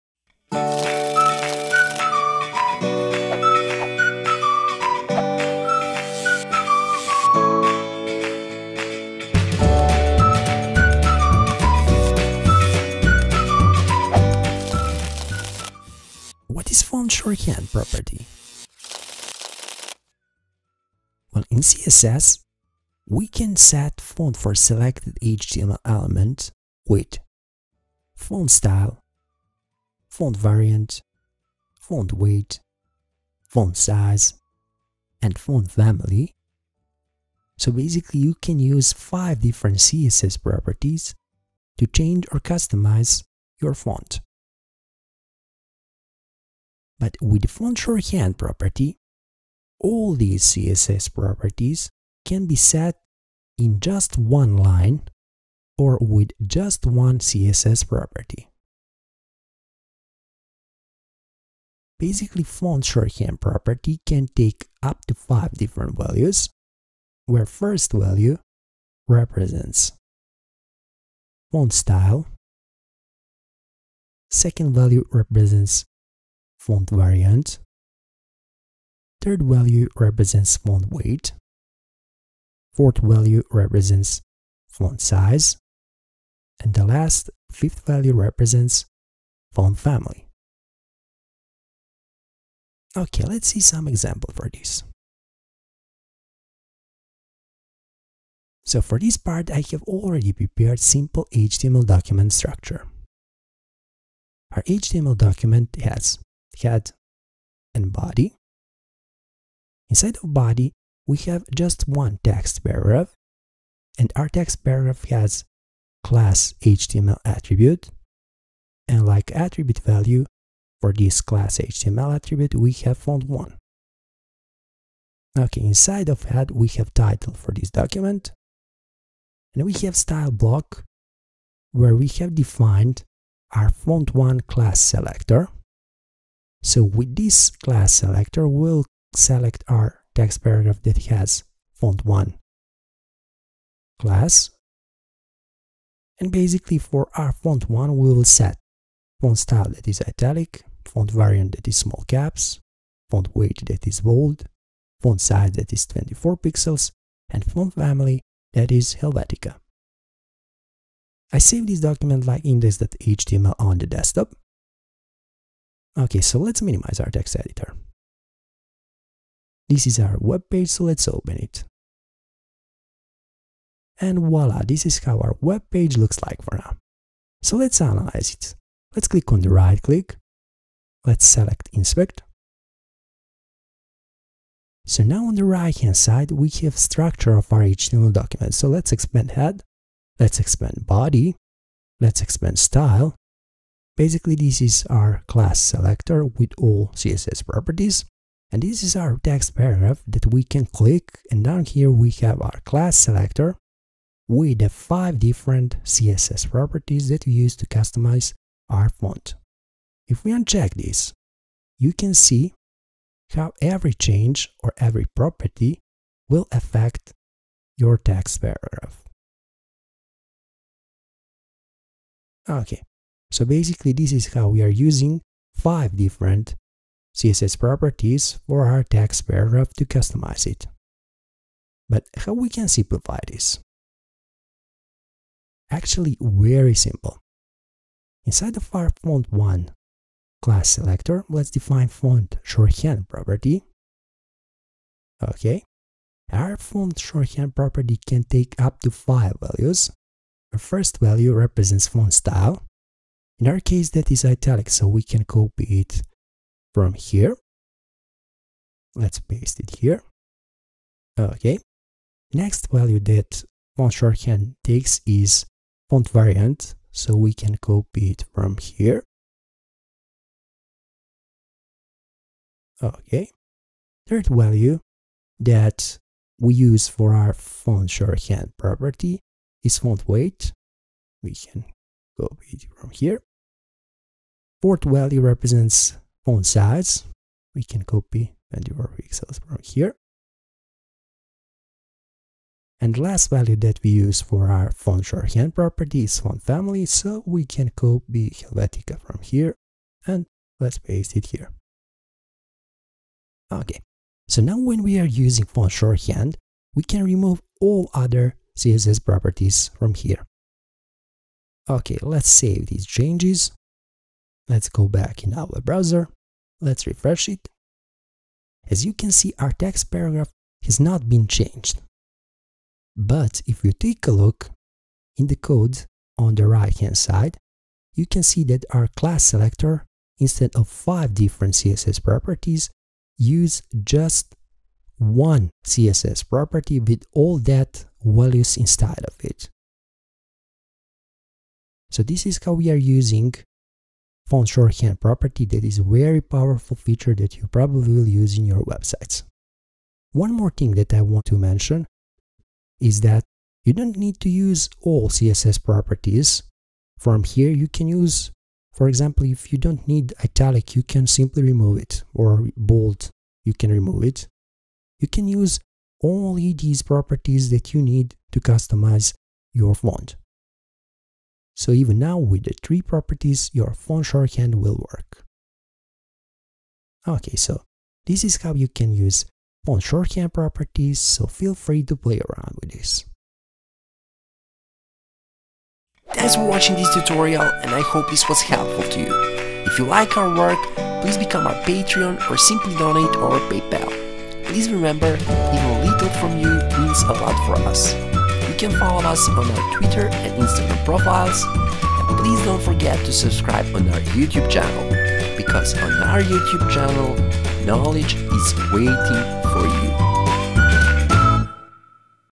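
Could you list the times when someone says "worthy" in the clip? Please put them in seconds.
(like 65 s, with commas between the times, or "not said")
not said.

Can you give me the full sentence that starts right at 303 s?
Okay, so now when we are using font shorthand, we can remove all other CSS properties from here.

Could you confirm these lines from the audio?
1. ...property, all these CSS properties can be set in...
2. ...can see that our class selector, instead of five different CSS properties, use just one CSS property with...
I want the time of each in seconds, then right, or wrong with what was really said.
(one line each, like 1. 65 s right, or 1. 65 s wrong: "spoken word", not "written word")
1. 48 s right
2. 328 s right.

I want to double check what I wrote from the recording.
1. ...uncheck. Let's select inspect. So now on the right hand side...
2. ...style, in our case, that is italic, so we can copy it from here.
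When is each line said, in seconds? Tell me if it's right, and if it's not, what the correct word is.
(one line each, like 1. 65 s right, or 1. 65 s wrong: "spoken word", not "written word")
1. 179 s wrong: "click", not "uncheck"
2. 252 s right.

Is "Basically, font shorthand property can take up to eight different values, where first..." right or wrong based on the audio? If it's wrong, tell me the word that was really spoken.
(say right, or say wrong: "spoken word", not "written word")
wrong: "five", not "eight".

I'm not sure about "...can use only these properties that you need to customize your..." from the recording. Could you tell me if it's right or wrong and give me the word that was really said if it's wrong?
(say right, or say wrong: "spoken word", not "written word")
right.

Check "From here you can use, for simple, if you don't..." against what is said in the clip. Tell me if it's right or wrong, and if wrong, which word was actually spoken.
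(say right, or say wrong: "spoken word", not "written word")
wrong: "example", not "simple".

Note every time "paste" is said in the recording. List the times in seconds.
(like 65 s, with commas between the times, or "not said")
259 s, 300 s.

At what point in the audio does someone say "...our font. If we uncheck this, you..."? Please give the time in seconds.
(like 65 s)
208 s.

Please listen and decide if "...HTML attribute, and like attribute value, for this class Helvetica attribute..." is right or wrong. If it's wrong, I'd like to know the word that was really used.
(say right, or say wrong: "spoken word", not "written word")
wrong: "HTML", not "Helvetica".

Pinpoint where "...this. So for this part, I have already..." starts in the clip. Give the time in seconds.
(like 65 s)
94 s.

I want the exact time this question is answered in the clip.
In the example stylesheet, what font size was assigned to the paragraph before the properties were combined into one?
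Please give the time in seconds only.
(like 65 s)
155 s.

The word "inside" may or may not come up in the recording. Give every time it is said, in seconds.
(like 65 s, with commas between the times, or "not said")
109 s, 125 s, 238 s, 338 s.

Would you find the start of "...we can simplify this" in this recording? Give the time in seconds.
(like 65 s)
232 s.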